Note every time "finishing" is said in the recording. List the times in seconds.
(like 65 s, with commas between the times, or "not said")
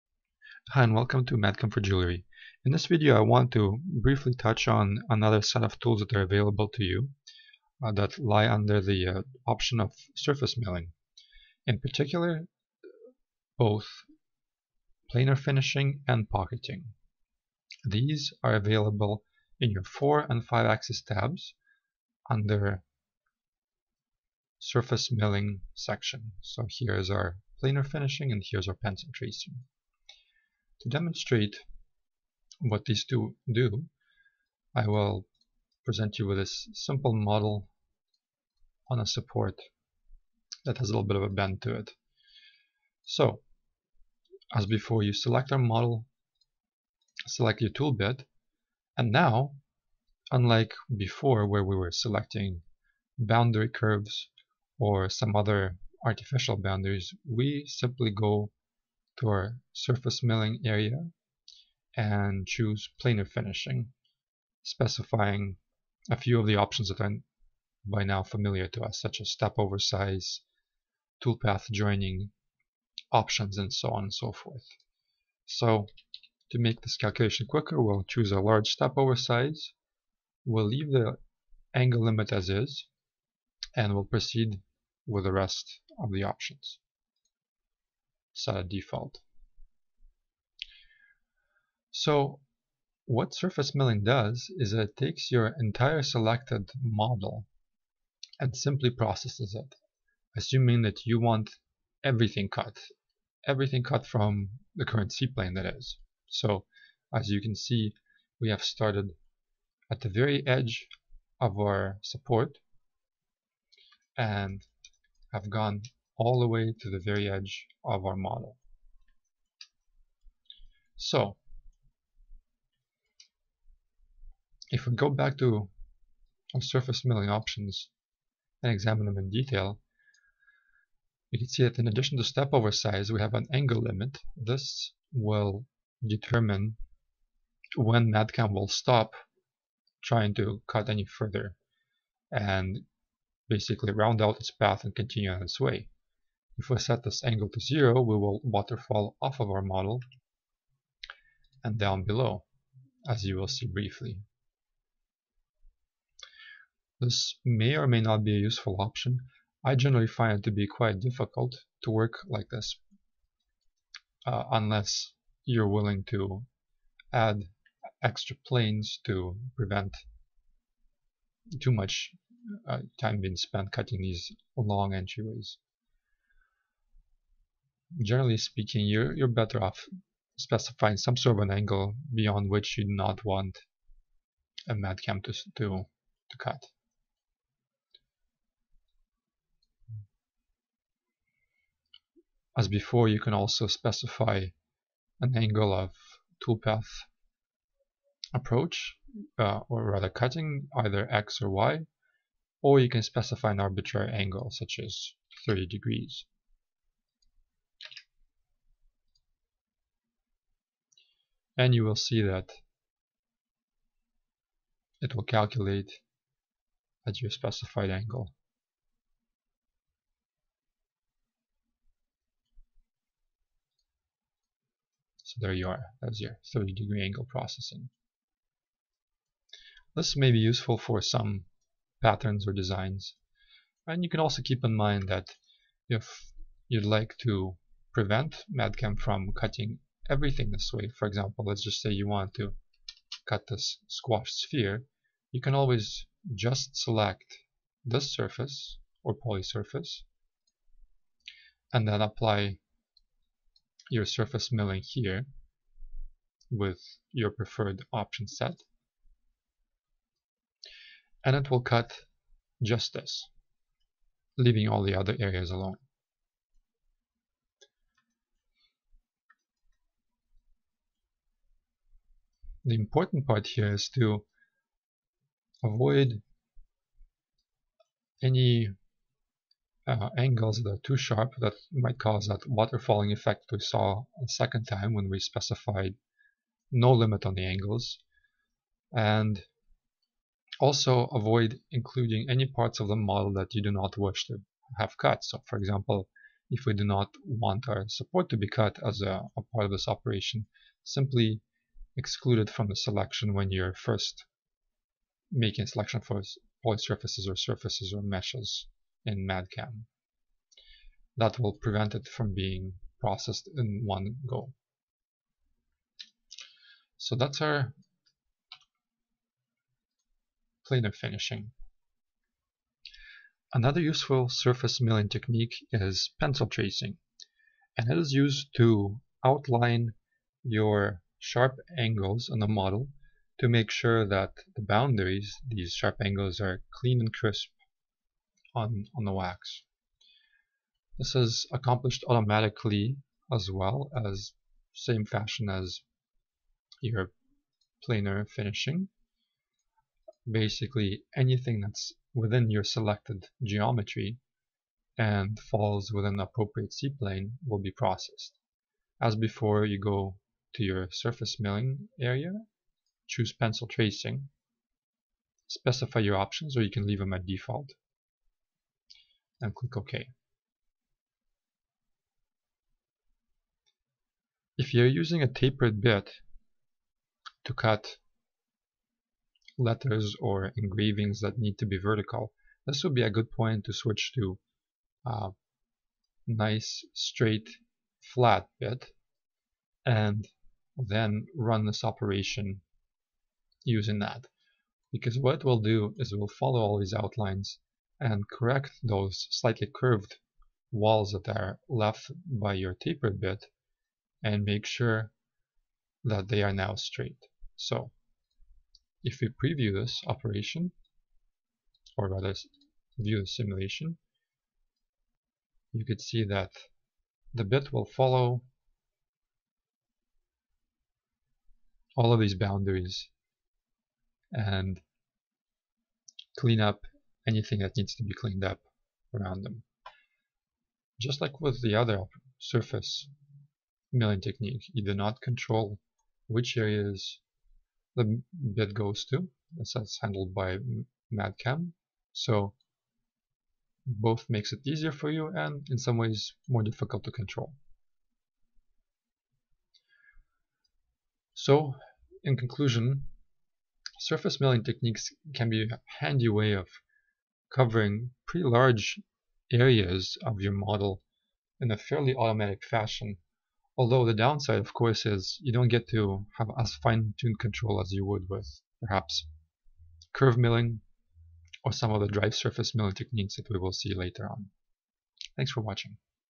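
15 s, 27 s, 63 s, 321 s, 348 s.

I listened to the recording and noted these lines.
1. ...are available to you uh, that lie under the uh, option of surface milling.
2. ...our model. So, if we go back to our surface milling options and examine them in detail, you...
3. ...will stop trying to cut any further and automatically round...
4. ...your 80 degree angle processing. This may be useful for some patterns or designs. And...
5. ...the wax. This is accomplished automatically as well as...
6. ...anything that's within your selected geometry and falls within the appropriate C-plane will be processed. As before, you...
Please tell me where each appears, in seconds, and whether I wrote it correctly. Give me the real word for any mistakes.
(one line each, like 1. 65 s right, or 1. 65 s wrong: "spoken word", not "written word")
1. 6 s right
2. 118 s right
3. 138 s wrong: "basically", not "automatically"
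4. 226 s wrong: "30", not "80"
5. 339 s right
6. 351 s right.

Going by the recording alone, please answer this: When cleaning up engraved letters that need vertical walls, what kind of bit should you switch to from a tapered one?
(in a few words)
straight flat bit.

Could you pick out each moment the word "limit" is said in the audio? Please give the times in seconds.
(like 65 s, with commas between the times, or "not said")
82 s, 133 s, 286 s.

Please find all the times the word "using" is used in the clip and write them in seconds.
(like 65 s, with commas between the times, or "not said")
374 s, 393 s.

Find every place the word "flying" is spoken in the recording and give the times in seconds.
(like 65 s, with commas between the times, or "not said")
not said.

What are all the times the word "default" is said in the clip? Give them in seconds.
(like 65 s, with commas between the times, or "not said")
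88 s, 367 s.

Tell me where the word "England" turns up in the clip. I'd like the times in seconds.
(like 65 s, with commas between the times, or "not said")
not said.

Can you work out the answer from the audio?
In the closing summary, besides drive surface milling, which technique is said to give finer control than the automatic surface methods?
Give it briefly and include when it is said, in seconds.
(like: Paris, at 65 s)
curve milling, at 470 s.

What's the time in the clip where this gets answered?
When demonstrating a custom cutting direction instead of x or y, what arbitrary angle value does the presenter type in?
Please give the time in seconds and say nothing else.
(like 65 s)
205 s.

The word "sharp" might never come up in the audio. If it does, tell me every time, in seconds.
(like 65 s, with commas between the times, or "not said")
280 s, 331 s, 335 s.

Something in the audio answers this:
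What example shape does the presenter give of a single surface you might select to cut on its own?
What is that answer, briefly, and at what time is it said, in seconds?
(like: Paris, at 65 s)
squash sphere, at 243 s.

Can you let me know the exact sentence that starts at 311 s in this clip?
That will prevent it from being processed in one go.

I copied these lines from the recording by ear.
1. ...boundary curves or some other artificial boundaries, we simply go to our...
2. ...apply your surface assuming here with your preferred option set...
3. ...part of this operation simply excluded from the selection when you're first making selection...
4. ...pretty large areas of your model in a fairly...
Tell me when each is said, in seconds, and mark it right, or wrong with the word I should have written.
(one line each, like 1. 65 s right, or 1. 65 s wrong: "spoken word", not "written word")
1. 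53 s right
2. 252 s wrong: "milling", not "assuming"
3. 299 s right
4. 458 s right.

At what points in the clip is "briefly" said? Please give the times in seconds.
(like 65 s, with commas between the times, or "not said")
3 s, 153 s.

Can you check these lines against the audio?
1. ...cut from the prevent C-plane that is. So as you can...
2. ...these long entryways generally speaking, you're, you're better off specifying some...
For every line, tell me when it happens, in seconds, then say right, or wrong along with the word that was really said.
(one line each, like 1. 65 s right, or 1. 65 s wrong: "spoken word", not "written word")
1. 103 s wrong: "current", not "prevent"
2. 174 s right.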